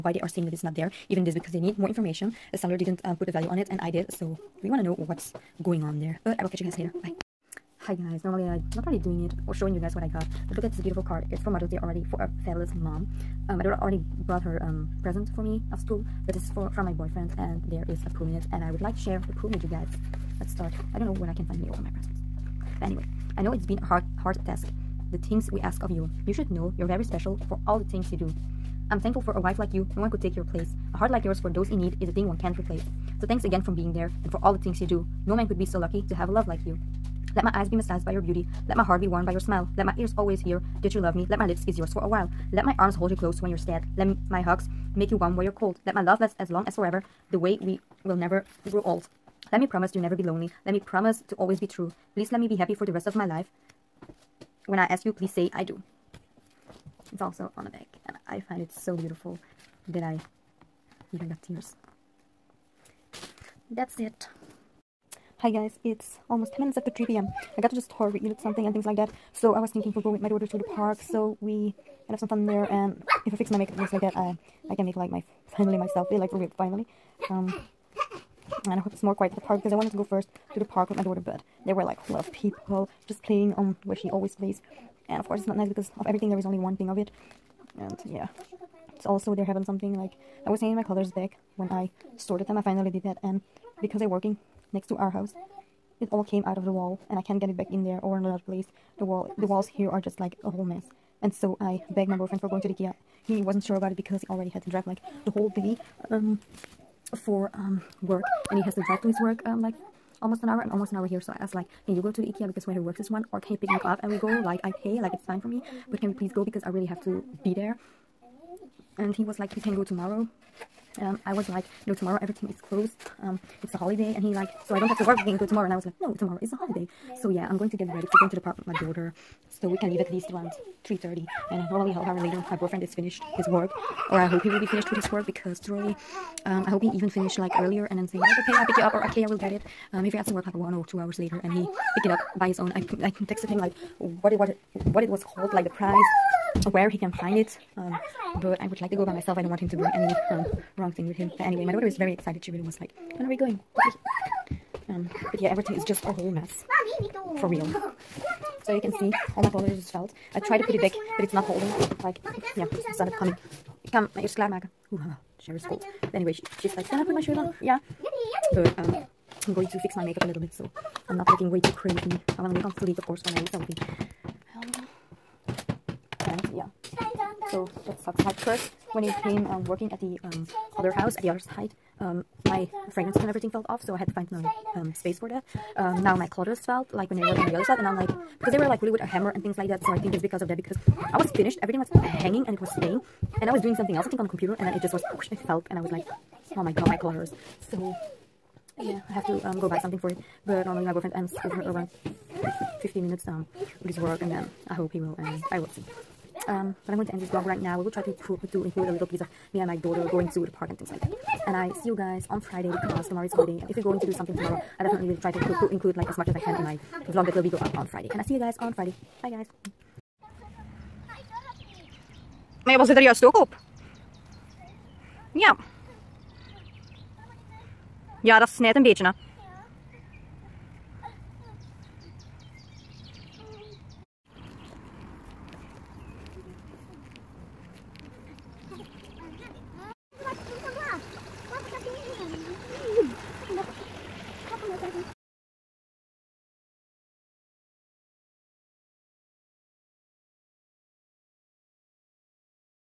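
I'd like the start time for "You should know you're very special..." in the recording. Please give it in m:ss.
0:26.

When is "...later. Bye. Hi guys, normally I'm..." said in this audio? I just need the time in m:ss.
0:06.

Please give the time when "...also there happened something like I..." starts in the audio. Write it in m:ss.
1:29.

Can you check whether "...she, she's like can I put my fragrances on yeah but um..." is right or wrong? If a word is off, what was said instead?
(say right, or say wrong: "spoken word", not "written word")
wrong: "shoes", not "fragrances".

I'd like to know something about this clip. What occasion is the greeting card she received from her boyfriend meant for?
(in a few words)
Mother's Day.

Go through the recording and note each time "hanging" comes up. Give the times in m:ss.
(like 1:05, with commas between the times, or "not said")
1:30, 3:12.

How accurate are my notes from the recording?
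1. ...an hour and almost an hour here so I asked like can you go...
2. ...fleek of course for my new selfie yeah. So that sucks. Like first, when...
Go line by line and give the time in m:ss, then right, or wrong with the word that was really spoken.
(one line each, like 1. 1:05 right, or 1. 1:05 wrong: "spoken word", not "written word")
1. 1:50 right
2. 2:52 right.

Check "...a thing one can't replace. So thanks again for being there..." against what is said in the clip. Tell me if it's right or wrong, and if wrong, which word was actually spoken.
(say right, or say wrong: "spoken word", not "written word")
right.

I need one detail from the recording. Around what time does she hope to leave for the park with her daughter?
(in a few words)
3:30.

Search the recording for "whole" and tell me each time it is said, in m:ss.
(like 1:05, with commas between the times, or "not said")
1:40, 1:45, 2:36.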